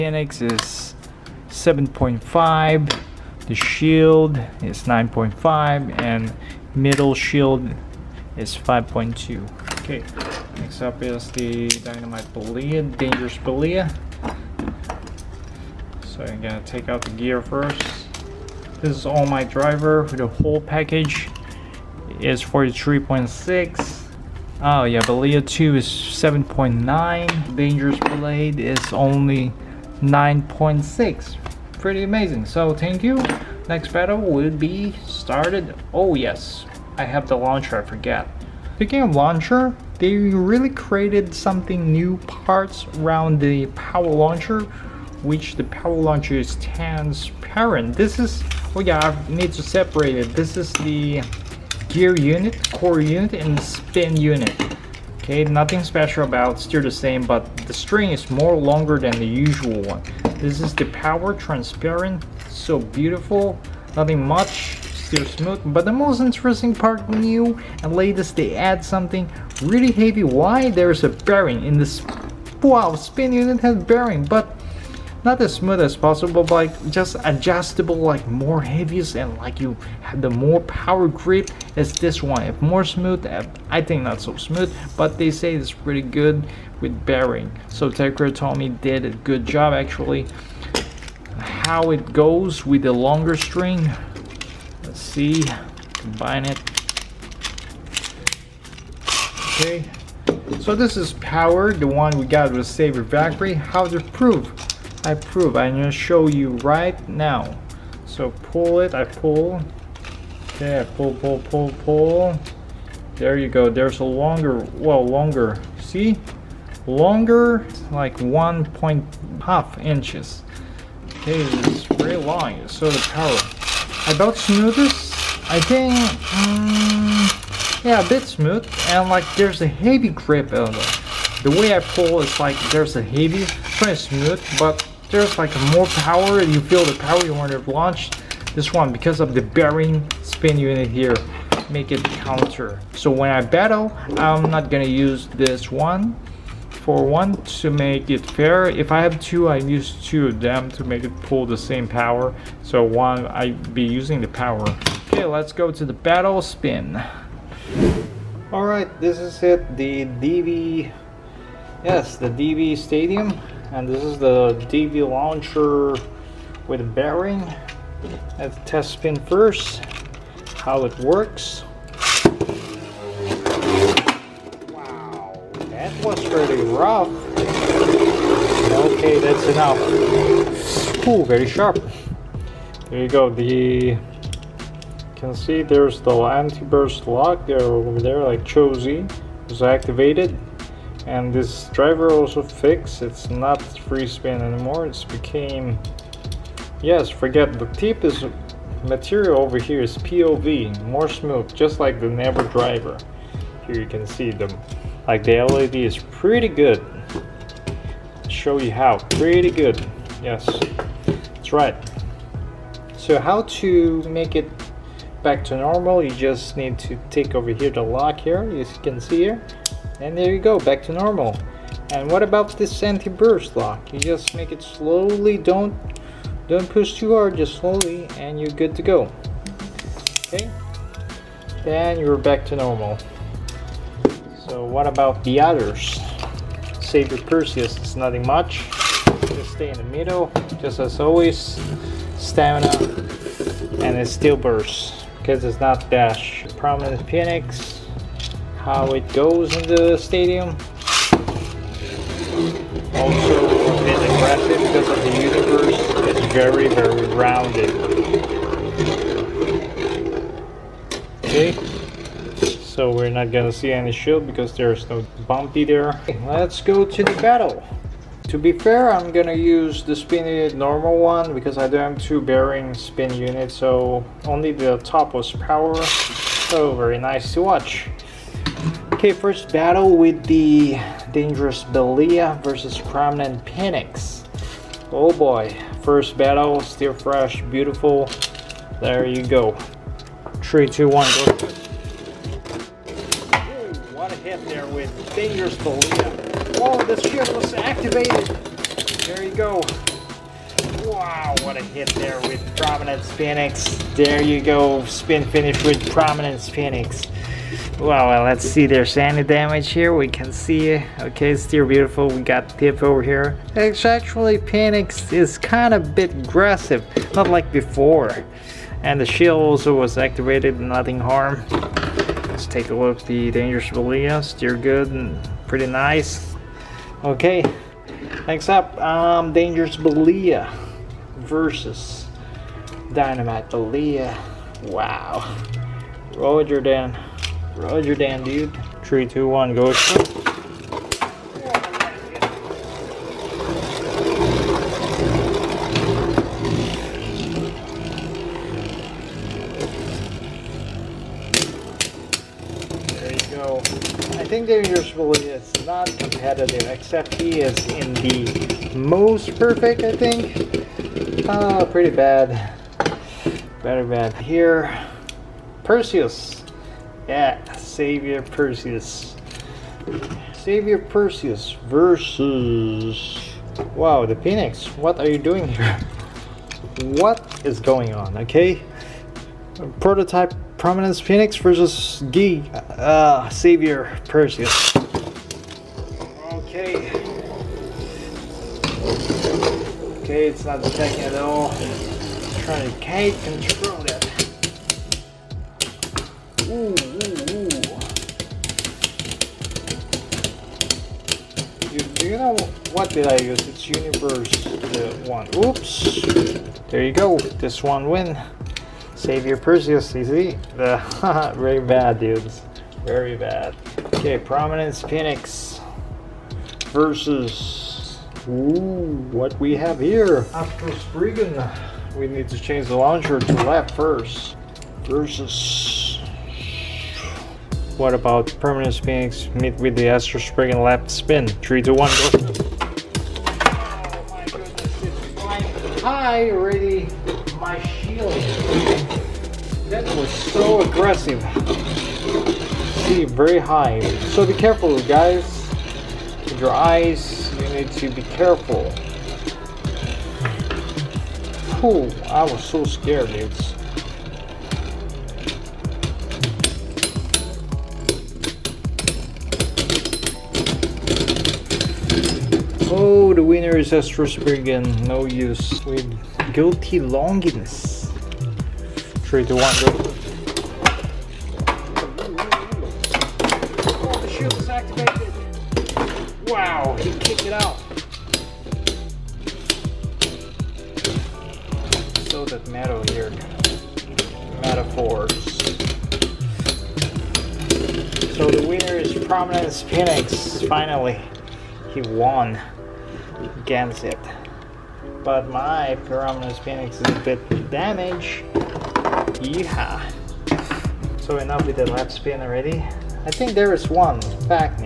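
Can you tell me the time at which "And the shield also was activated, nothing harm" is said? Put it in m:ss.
5:18.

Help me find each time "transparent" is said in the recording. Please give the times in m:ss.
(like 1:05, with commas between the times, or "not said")
0:46, 1:01.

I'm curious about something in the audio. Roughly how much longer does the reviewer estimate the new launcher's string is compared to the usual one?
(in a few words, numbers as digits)
1.5 inches.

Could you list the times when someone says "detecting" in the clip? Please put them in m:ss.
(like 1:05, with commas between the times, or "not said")
6:30.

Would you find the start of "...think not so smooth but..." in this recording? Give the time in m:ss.
1:23.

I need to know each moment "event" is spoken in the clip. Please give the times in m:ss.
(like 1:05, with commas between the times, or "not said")
not said.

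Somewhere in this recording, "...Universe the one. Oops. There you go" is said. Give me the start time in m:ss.
6:43.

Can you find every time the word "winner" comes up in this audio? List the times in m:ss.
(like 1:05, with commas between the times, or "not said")
7:43, 8:08.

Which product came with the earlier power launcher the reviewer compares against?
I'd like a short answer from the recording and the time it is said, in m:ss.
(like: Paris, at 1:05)
Saber Factory, at 1:42.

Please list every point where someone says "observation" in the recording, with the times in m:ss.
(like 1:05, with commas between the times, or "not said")
not said.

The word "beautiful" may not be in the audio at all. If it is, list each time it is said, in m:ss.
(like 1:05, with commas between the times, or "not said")
1:02, 4:47, 5:11.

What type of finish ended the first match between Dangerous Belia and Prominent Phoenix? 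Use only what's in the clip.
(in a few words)
spin finish.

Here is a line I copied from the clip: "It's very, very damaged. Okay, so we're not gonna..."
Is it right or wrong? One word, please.
wrong.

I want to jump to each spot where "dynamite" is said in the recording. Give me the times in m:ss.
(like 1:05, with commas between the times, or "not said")
0:11, 5:32.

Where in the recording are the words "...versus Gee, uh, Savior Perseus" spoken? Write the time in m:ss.
6:21.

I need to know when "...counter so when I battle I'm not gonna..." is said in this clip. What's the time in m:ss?
2:22.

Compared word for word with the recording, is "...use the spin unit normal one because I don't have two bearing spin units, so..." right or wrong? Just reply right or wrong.
right.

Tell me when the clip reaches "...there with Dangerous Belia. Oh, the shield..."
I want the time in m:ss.
4:54.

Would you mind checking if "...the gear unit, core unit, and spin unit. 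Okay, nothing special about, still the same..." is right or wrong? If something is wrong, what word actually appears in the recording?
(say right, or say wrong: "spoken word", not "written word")
right.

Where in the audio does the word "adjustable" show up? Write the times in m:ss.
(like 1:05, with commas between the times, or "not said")
1:17.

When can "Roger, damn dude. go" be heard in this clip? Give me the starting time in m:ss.
5:37.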